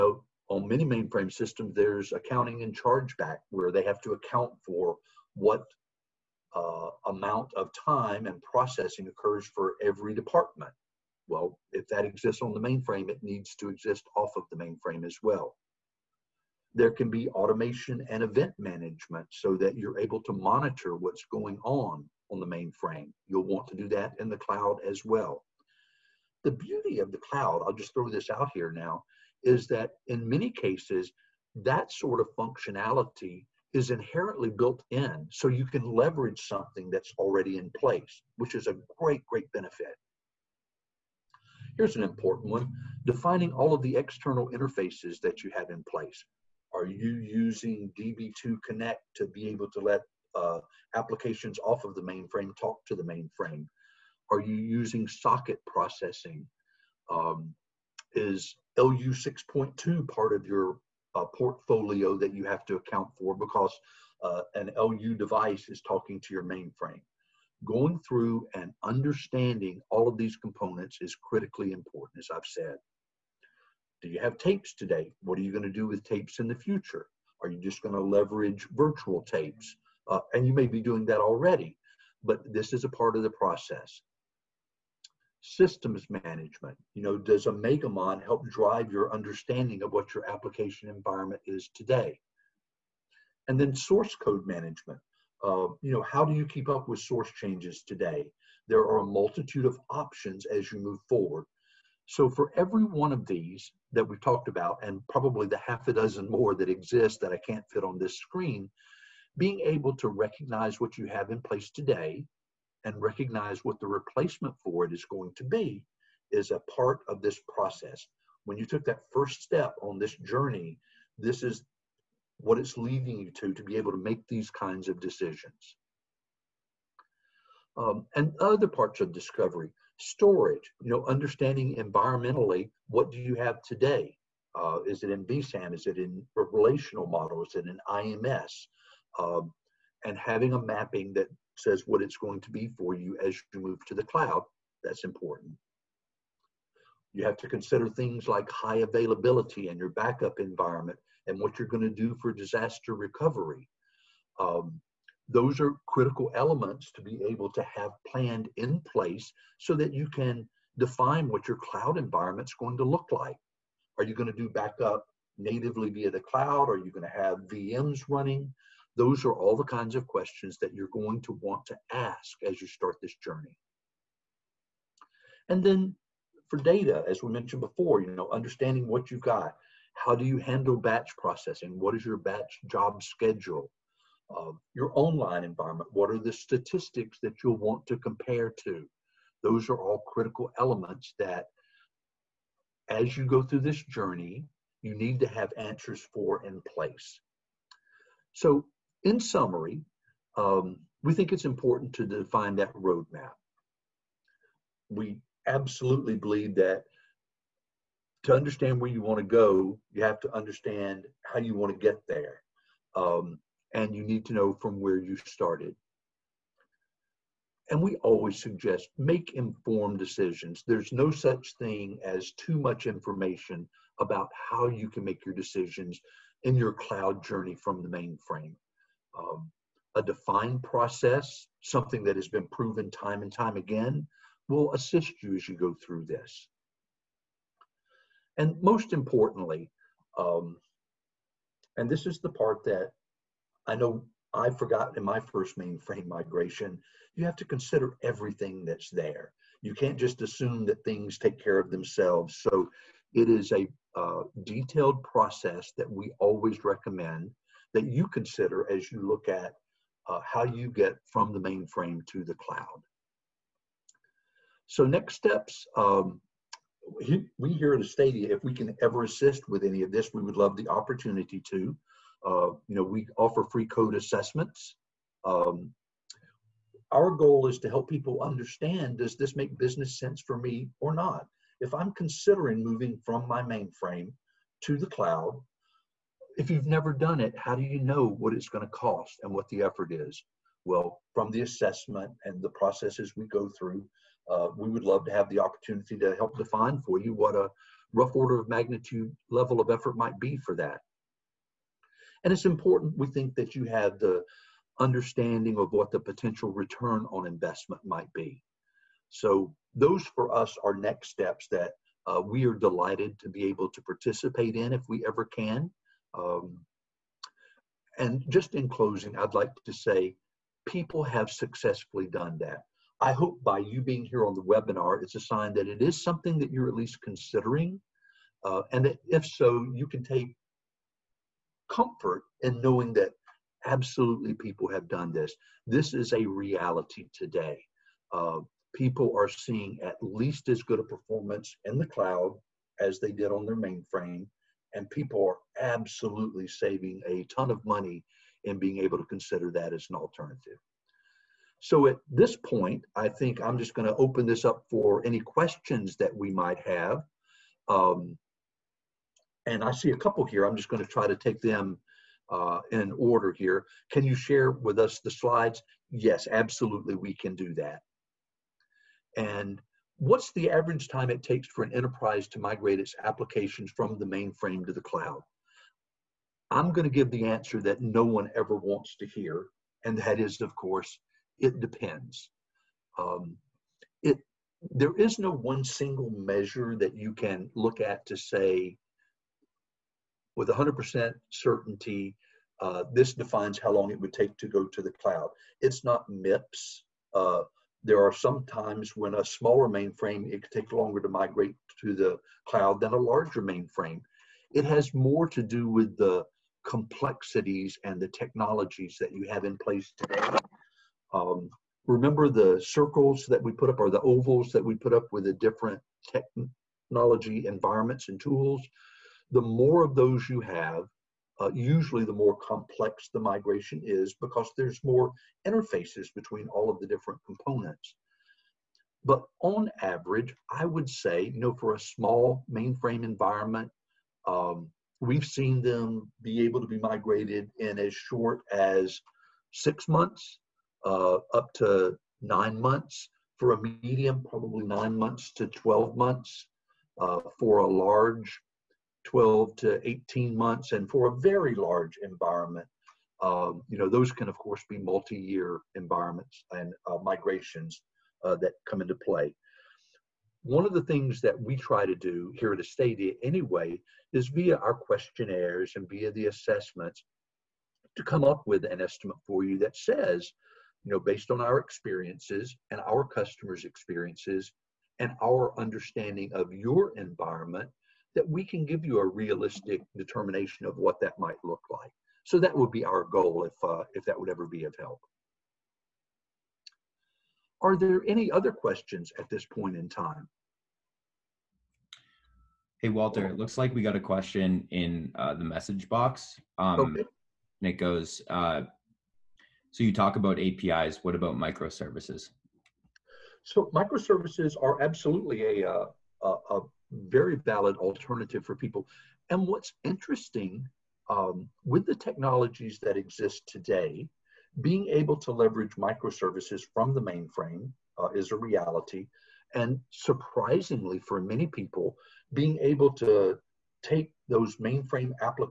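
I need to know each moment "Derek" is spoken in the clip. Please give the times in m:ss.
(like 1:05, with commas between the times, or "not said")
not said.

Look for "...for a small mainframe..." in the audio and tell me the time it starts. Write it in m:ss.
7:11.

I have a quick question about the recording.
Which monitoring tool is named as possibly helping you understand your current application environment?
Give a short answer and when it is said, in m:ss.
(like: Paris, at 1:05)
Omegamon, at 1:27.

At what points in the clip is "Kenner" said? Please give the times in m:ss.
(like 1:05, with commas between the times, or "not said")
not said.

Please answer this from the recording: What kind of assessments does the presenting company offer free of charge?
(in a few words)
code assessments.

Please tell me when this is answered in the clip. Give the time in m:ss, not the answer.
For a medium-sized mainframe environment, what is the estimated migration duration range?
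7:24.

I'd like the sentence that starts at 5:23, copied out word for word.
I hope by you being here on the webinar, it's a sign that it is something that you're at least considering.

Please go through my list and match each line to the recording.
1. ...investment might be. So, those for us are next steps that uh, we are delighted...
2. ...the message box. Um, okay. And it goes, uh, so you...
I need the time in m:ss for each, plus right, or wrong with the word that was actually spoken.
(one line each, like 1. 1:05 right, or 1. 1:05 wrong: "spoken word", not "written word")
1. 5:07 right
2. 8:15 right.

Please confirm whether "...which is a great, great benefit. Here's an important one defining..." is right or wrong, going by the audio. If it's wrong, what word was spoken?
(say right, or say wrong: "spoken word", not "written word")
right.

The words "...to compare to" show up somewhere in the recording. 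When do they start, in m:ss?
3:07.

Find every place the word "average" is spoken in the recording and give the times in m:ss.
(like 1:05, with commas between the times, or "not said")
6:10, 7:09.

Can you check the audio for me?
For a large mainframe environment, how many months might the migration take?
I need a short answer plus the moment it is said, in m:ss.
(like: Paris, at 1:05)
12 to 18 months, at 7:29.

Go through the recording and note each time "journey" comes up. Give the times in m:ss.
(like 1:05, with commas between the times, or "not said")
2:00, 2:53, 3:13, 3:47.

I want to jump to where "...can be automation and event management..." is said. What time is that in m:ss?
0:16.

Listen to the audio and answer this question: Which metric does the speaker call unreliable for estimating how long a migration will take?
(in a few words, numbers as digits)
MIPS.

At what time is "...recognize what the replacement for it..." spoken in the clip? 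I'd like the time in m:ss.
1:53.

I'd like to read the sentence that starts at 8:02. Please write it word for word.
So that would be our goal if, uh, if that would ever be of help.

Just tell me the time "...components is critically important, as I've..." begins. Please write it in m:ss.
1:10.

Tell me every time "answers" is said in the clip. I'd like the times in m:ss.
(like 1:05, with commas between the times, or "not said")
3:15, 6:17.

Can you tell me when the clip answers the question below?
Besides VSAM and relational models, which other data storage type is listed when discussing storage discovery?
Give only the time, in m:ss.
2:17.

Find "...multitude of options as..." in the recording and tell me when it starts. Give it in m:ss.
1:39.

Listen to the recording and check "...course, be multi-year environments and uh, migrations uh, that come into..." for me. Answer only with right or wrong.
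right.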